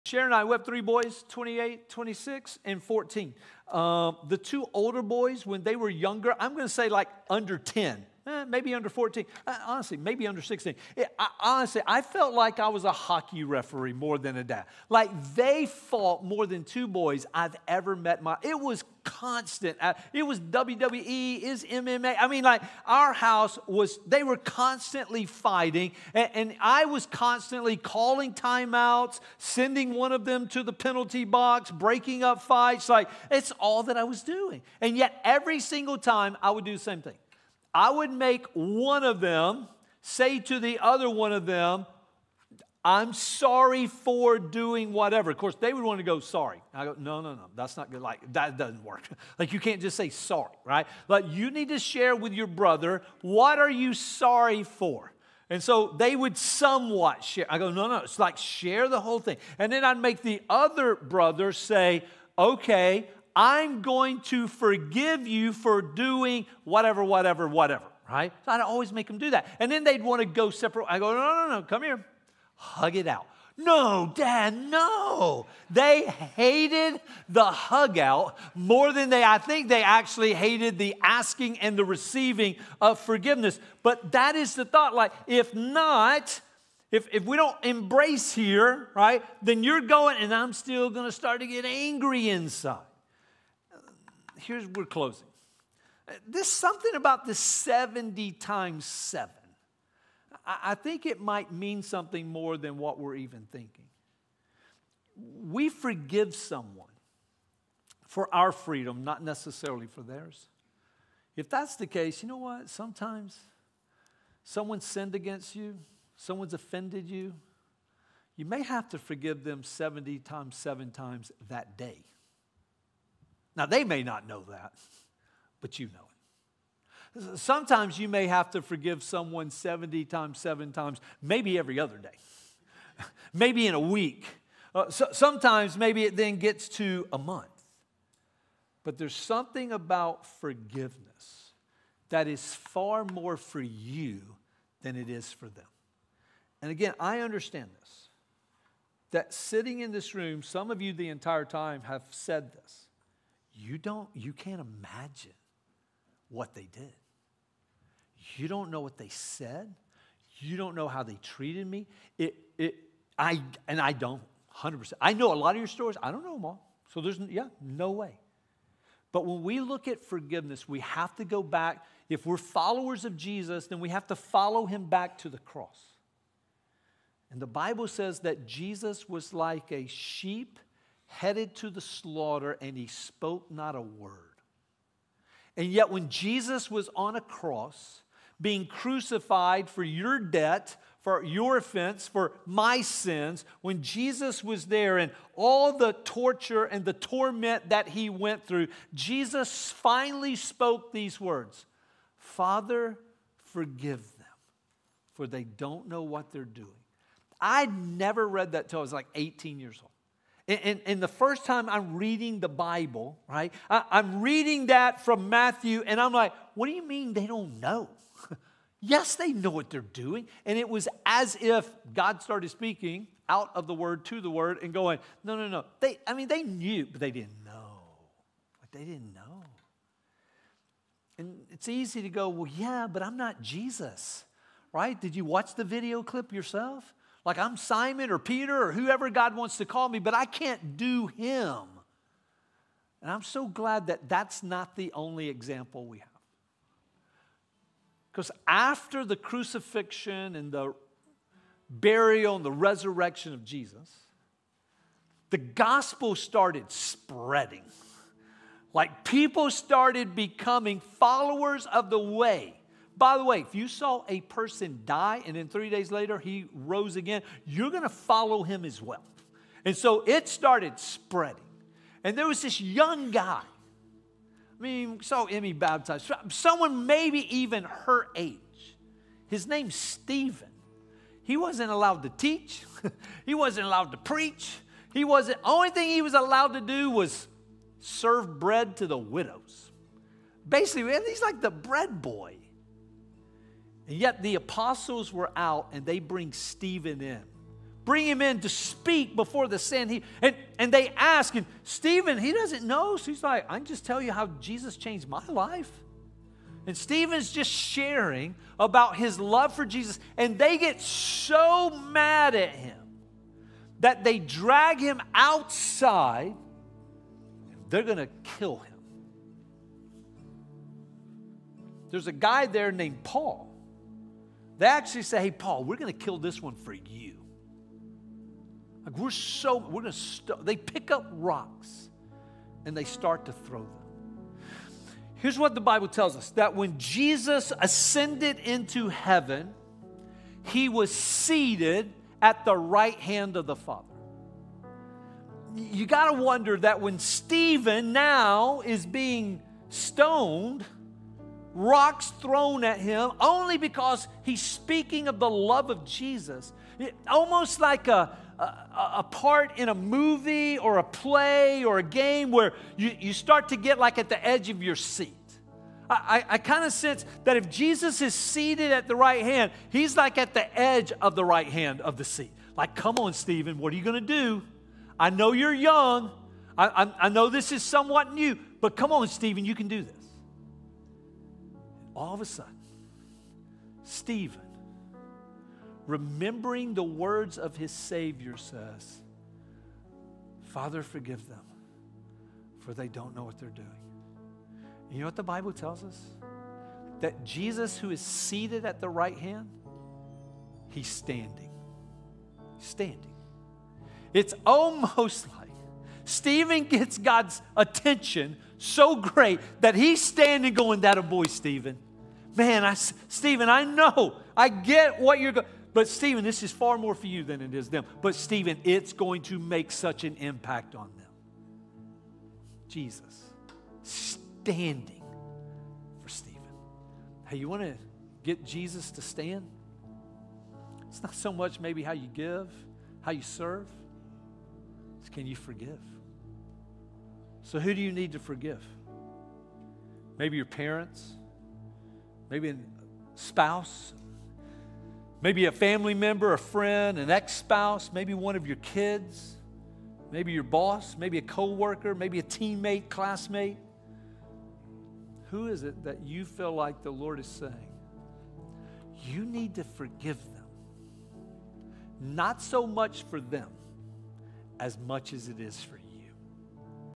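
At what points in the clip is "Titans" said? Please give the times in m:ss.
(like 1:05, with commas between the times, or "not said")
not said.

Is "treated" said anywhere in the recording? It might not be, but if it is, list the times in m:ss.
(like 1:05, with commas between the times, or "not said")
2:41.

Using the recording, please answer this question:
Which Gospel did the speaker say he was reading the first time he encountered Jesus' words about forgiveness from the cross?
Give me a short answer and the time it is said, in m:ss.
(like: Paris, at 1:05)
Matthew, at 3:35.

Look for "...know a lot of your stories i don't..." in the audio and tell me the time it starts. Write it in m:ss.
2:45.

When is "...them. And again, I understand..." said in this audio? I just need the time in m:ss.
2:25.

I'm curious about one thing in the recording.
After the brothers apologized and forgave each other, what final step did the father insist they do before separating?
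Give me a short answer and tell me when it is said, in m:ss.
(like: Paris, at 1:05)
Hug it out, at 1:12.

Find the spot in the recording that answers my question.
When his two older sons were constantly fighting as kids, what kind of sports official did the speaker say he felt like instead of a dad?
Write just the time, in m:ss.
0:12.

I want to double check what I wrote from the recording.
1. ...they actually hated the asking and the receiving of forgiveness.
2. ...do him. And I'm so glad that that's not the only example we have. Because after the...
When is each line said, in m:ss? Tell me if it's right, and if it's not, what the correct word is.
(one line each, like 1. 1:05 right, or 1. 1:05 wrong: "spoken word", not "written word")
1. 1:19 right
2. 4:00 right.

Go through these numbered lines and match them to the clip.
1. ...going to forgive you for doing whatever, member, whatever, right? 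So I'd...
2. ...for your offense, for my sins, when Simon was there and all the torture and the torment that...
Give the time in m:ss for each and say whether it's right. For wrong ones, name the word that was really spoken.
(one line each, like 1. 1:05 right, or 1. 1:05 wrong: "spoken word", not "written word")
1. 1:03 wrong: "whatever", not "member"
2. 3:11 wrong: "Jesus", not "Simon".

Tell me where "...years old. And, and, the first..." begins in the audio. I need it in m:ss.
3:29.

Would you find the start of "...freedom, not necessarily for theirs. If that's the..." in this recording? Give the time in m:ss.
1:48.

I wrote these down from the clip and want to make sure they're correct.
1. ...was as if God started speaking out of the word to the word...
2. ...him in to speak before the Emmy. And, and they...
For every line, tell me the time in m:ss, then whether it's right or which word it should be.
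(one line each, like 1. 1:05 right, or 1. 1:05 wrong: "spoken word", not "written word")
1. 3:40 right
2. 4:58 wrong: "Sanhedrin", not "Emmy".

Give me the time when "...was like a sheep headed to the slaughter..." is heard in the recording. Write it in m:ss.
2:59.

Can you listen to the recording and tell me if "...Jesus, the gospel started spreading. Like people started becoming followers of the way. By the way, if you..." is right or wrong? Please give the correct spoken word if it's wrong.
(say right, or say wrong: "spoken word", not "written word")
right.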